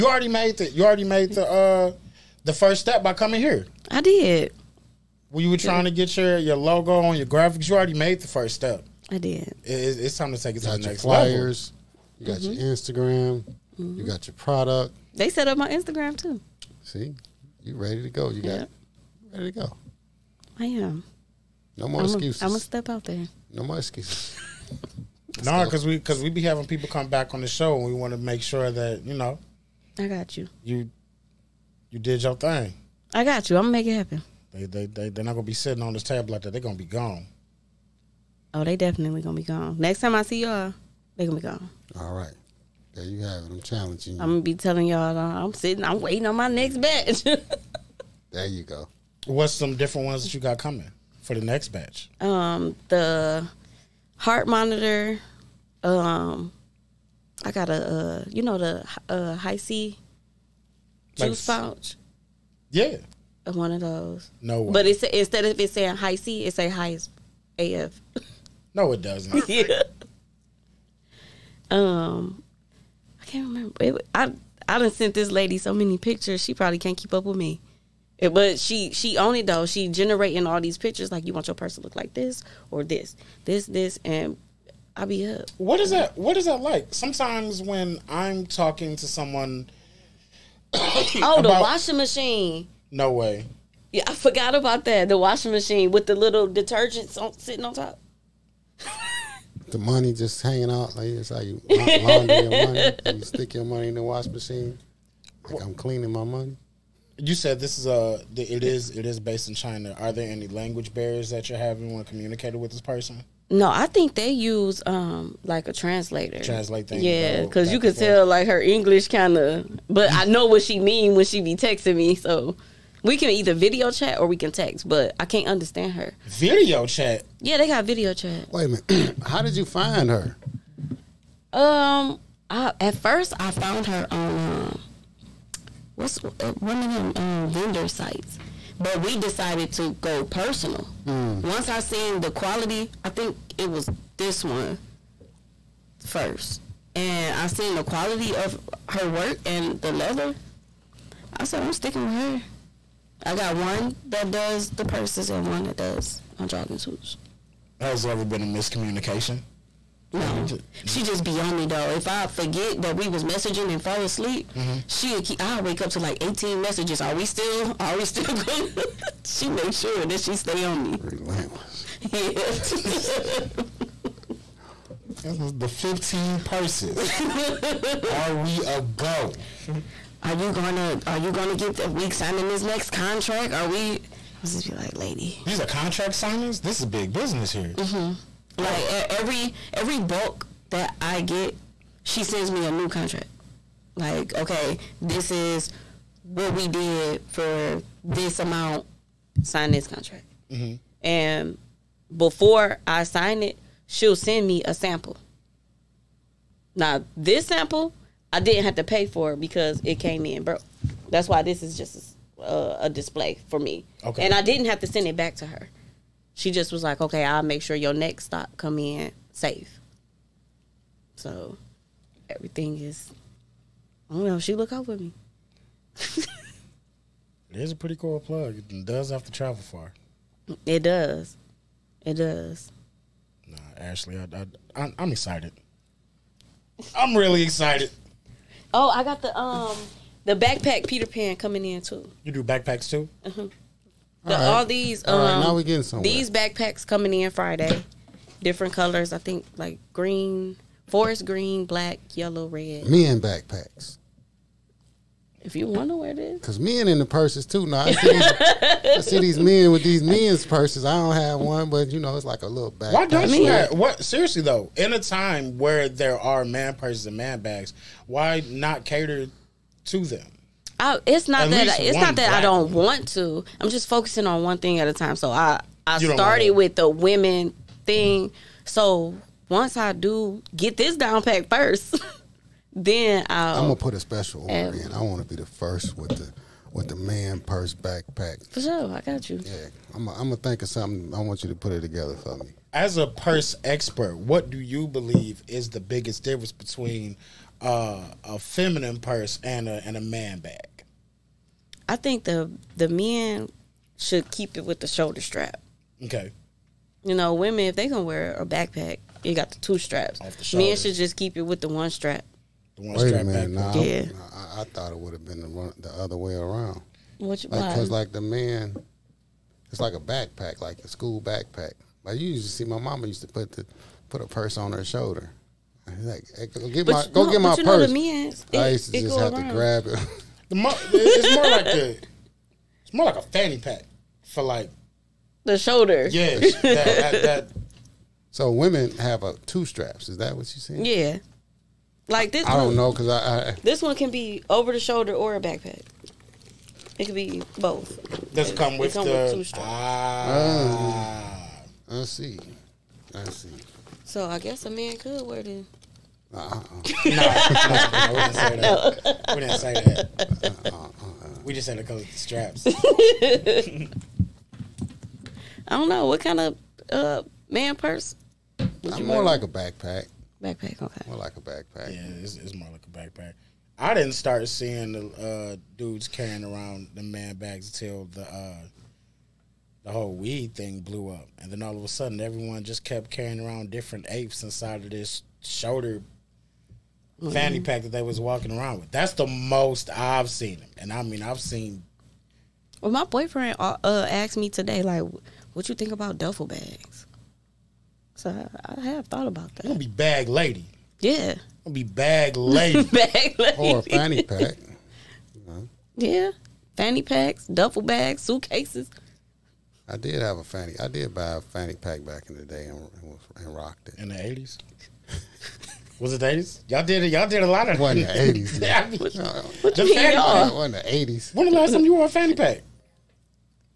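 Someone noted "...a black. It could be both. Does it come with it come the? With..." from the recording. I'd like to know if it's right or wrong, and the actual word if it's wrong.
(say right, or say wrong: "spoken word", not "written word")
wrong: "backpack", not "black".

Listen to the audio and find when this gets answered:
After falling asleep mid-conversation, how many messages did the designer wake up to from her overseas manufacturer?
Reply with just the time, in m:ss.
2:46.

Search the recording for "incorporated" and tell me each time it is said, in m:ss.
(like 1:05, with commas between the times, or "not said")
not said.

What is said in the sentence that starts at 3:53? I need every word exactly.
Nah, Ashley, I, I, I'm excited.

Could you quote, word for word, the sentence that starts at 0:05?
When you were trying to get your, your logo on your graphics, you already made the first step.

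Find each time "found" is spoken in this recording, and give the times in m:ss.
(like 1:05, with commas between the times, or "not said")
2:13.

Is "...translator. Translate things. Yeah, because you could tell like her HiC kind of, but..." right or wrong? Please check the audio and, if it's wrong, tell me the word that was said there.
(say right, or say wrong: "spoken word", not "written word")
wrong: "English", not "HiC".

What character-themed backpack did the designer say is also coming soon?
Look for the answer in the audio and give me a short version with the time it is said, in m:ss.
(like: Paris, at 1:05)
Peter Pan, at 4:00.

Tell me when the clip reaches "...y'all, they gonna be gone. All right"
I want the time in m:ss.
0:40.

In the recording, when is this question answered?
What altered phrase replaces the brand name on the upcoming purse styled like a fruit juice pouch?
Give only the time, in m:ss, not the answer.
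1:06.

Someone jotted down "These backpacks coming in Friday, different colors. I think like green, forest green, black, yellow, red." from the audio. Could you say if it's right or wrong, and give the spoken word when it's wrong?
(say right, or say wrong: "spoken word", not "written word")
right.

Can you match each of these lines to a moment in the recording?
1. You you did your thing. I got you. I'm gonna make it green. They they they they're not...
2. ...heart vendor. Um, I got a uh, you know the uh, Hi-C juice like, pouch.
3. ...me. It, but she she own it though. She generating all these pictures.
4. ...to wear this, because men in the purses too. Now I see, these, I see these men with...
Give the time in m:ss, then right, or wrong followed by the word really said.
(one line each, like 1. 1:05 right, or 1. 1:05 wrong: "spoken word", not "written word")
1. 0:30 wrong: "happen", not "green"
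2. 0:54 wrong: "monitor", not "vendor"
3. 1:17 right
4. 4:15 right.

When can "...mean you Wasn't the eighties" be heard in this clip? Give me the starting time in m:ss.
6:59.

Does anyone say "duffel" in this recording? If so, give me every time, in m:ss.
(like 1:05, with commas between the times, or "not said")
6:36, 6:47.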